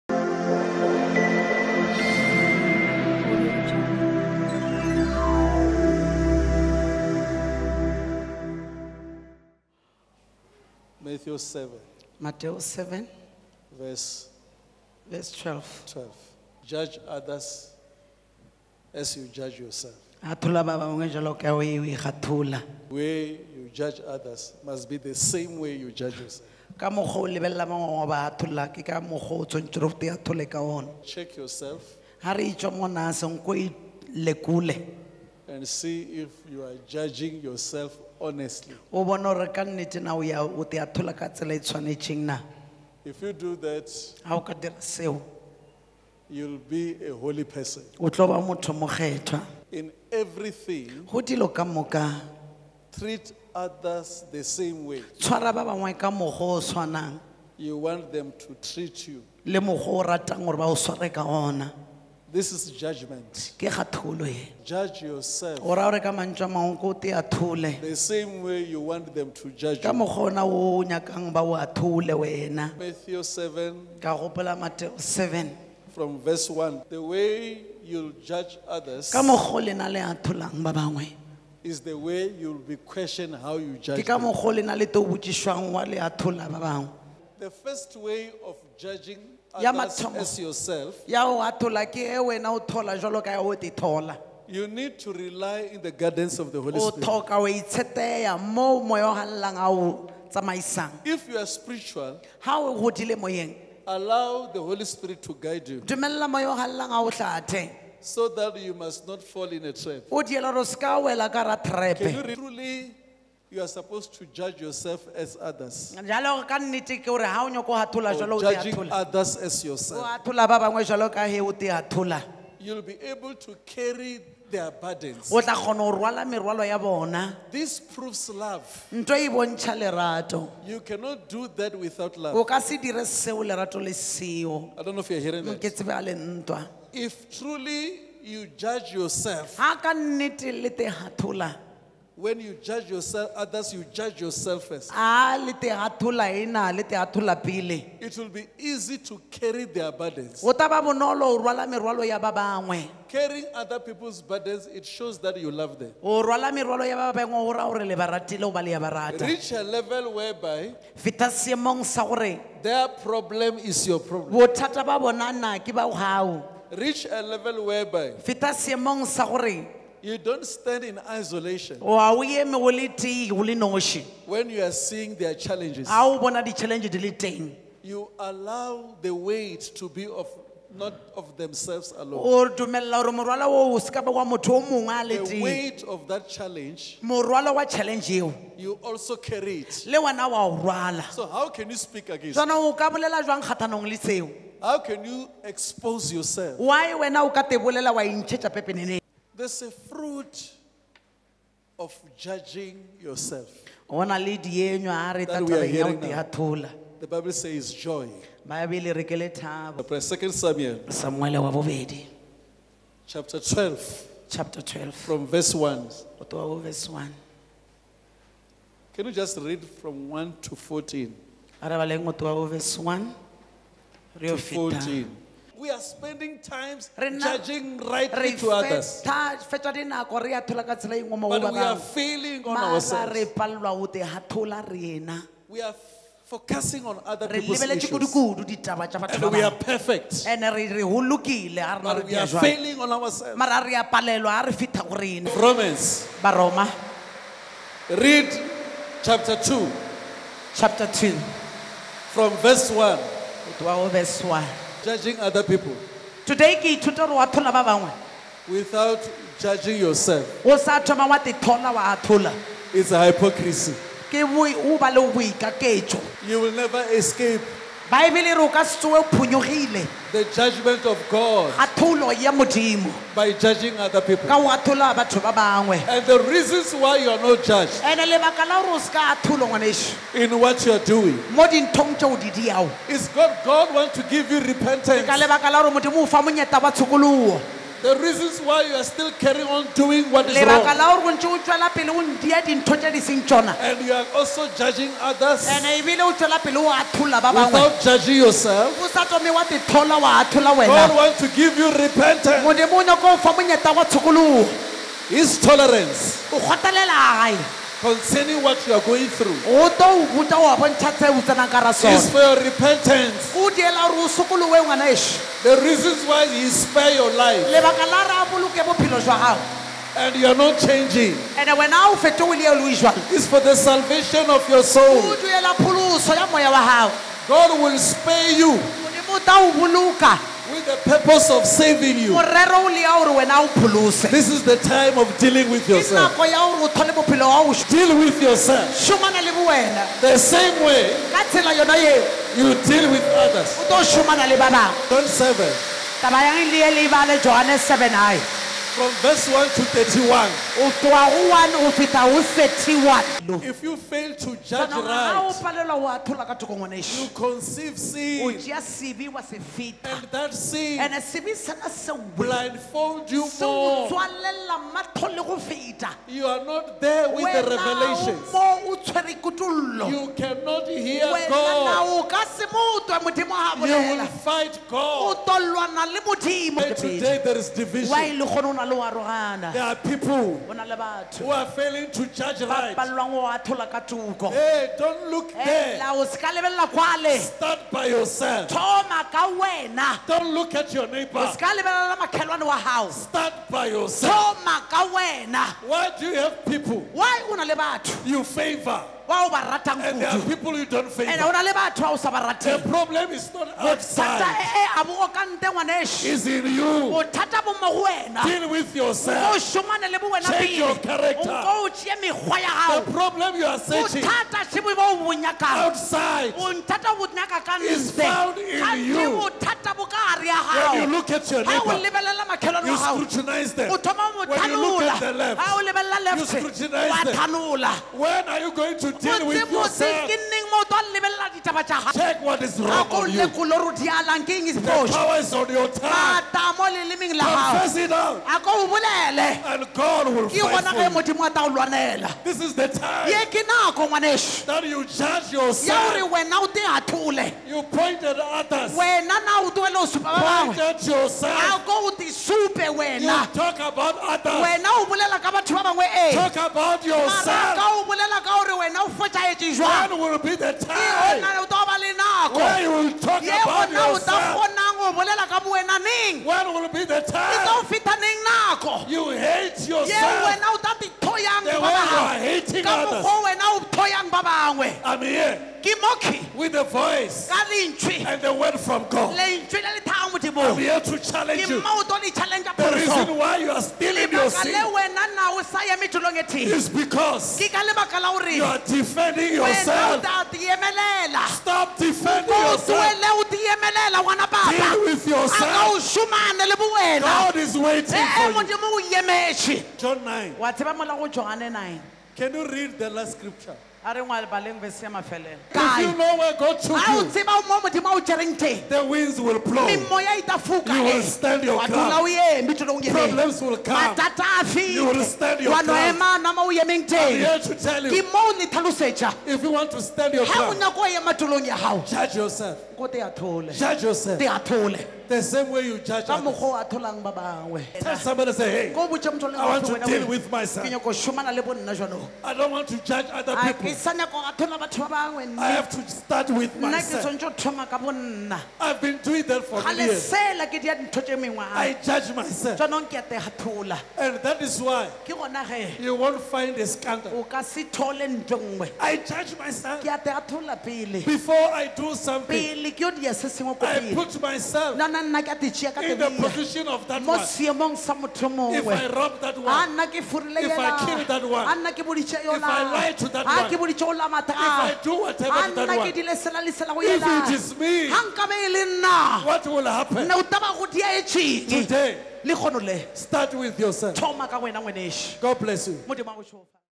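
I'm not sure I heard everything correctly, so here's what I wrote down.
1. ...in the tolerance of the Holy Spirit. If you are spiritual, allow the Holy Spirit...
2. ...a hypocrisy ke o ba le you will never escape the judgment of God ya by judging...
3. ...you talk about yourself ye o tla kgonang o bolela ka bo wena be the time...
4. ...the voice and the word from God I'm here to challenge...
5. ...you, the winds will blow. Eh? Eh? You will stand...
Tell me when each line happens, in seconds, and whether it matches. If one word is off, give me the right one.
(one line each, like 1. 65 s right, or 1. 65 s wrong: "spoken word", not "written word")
1. 95 s wrong: "guidance", not "tolerance"
2. 262 s right
3. 462 s right
4. 476 s right
5. 506 s right.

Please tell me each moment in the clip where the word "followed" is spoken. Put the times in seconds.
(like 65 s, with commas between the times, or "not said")
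not said.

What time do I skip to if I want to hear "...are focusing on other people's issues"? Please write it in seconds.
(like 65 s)
235 s.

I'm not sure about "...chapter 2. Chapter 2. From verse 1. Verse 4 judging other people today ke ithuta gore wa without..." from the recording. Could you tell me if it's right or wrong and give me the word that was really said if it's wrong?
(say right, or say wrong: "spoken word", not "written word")
wrong: "1", not "4".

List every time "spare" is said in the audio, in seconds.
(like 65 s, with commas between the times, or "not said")
316 s, 327 s.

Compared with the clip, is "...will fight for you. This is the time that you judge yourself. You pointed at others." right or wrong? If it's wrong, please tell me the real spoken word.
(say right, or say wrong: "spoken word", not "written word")
right.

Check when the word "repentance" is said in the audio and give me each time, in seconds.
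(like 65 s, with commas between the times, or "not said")
284 s, 301 s, 312 s.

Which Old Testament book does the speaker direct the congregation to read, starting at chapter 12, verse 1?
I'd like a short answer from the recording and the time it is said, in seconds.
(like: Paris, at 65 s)
Second Samuel, at 208 s.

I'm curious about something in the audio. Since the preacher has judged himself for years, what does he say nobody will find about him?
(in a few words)
A scandal.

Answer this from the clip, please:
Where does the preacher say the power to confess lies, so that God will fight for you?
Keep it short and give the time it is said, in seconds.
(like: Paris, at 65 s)
Your tongue, at 435 s.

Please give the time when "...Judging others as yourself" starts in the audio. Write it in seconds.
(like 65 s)
118 s.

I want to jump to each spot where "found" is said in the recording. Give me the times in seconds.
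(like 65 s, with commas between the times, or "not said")
417 s.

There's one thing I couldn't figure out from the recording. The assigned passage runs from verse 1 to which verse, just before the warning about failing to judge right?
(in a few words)
31.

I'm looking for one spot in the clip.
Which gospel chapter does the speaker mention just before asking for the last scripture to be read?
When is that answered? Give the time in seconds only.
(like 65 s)
499 s.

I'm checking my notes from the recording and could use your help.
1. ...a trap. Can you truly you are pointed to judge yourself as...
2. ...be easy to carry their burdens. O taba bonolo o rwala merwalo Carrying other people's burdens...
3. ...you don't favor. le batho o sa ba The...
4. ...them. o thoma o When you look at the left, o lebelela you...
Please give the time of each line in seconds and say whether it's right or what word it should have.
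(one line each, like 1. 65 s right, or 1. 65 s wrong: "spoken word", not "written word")
1. 109 s wrong: "supposed", not "pointed"
2. 148 s right
3. 400 s right
4. 423 s right.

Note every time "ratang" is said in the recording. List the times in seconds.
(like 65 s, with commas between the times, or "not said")
399 s.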